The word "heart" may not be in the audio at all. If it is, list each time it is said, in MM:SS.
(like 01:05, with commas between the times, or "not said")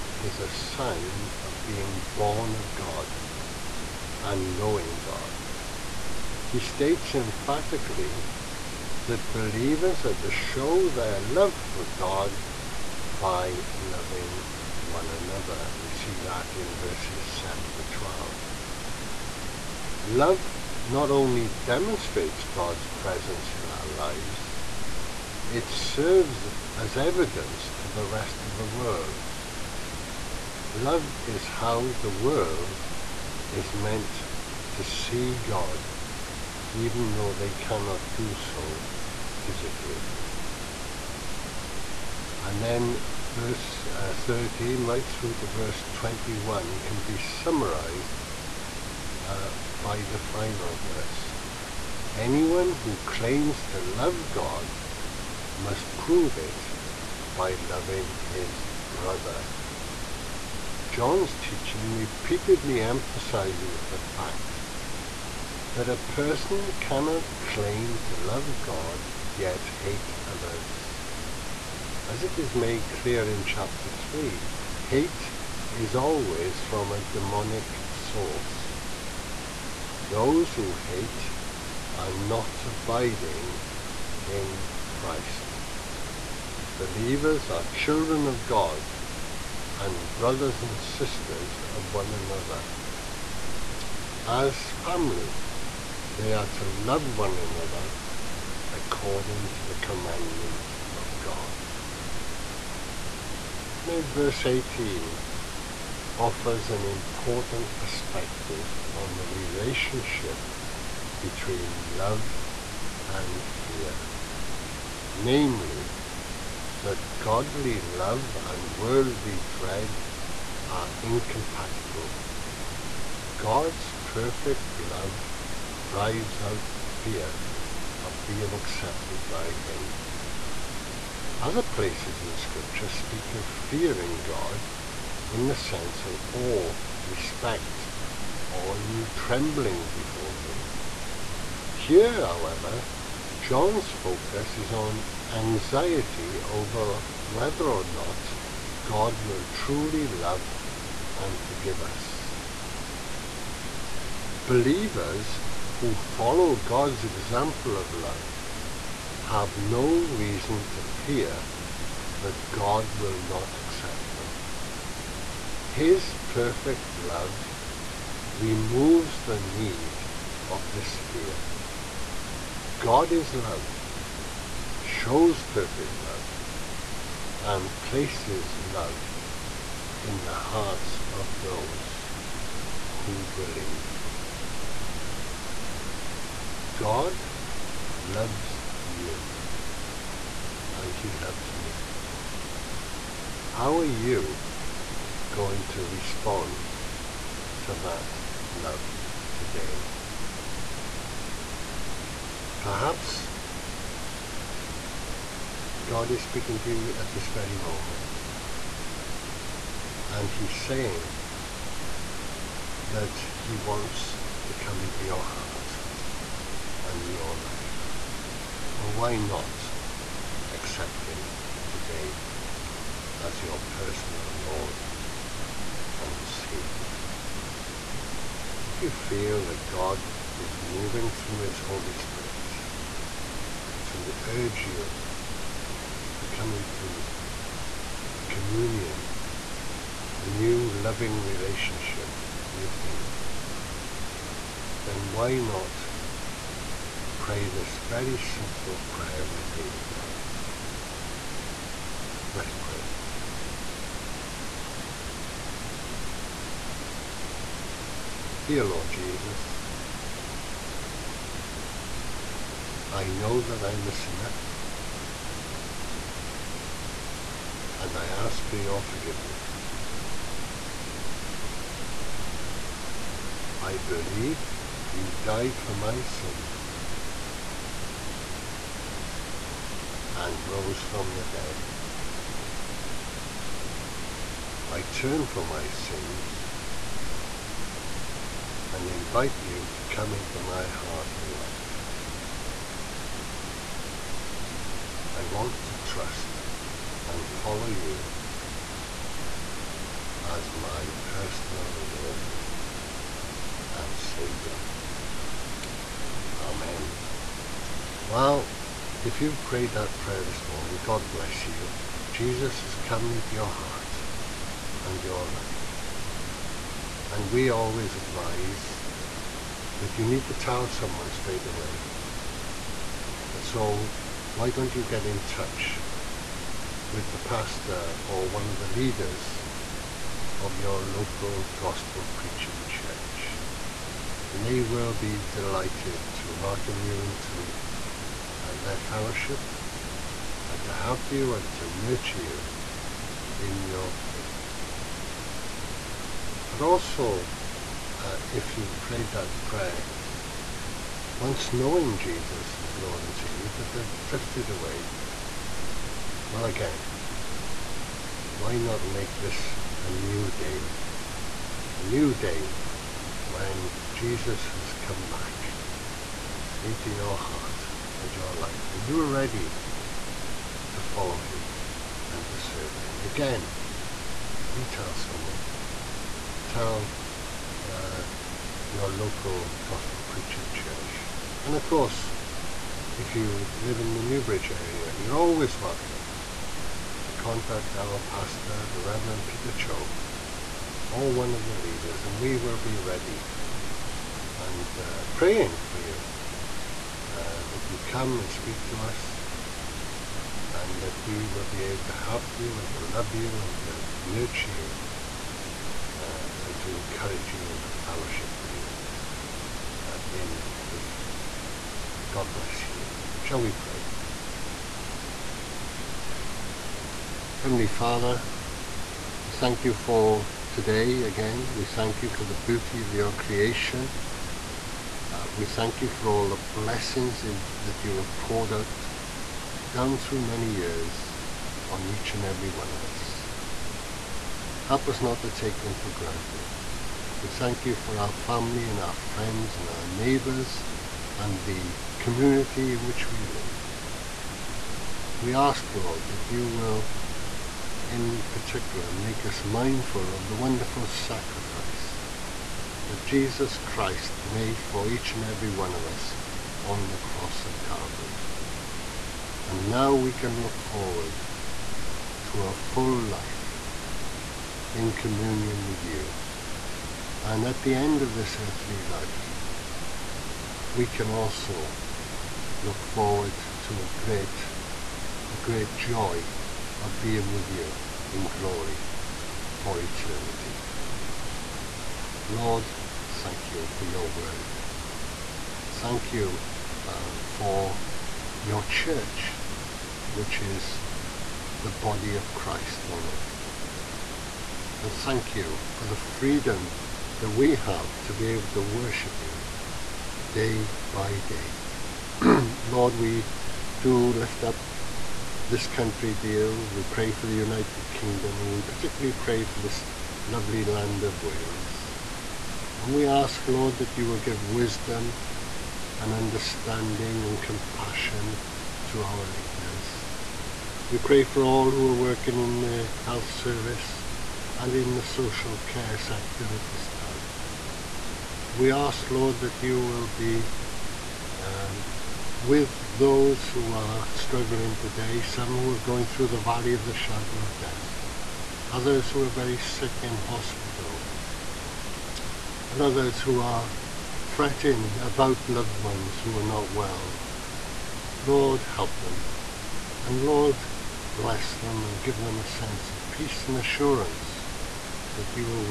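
03:00, 03:35, 04:50, 05:13, 06:07.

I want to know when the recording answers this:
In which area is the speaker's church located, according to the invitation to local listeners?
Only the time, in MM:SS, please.
06:24.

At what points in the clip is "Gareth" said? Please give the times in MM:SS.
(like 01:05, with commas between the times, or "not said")
not said.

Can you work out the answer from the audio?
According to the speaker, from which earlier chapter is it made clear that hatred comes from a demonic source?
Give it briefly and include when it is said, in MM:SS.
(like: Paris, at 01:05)
Chapter 3, at 01:13.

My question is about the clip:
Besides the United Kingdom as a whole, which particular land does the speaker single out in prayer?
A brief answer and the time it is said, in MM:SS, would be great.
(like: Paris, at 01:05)
Wales, at 08:31.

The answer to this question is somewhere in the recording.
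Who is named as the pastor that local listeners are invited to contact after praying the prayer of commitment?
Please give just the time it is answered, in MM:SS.
06:28.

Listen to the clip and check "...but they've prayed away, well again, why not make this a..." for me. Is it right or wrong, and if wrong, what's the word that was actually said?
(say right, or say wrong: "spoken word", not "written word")
wrong: "drifted", not "prayed".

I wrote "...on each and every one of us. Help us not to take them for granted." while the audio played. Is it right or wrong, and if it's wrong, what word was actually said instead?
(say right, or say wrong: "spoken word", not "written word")
right.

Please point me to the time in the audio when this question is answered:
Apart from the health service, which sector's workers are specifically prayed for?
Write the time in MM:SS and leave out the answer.
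08:45.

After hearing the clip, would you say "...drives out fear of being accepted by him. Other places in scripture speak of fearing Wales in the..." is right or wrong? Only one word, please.
wrong.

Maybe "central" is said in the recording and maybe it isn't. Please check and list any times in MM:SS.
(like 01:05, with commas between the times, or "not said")
not said.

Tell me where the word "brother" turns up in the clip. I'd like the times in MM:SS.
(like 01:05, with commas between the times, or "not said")
00:58, 01:30.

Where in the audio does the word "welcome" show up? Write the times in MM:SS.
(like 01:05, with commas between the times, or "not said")
05:36, 06:25.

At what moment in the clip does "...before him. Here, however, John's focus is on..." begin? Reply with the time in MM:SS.
02:19.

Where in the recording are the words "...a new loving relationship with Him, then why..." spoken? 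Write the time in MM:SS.
04:00.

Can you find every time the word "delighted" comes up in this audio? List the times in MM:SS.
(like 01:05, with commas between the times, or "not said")
05:35.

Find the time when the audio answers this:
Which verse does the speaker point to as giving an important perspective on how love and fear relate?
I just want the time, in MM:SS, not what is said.
01:44.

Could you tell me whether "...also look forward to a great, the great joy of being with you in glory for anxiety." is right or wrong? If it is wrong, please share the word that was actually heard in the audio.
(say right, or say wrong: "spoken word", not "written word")
wrong: "eternity", not "anxiety".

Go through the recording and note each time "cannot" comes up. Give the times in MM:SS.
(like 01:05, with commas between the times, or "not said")
00:37, 01:06.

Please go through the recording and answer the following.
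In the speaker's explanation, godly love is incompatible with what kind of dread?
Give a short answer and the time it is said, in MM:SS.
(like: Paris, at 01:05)
Worldly dread, at 01:58.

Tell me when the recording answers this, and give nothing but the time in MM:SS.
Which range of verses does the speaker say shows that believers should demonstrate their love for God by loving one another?
00:16.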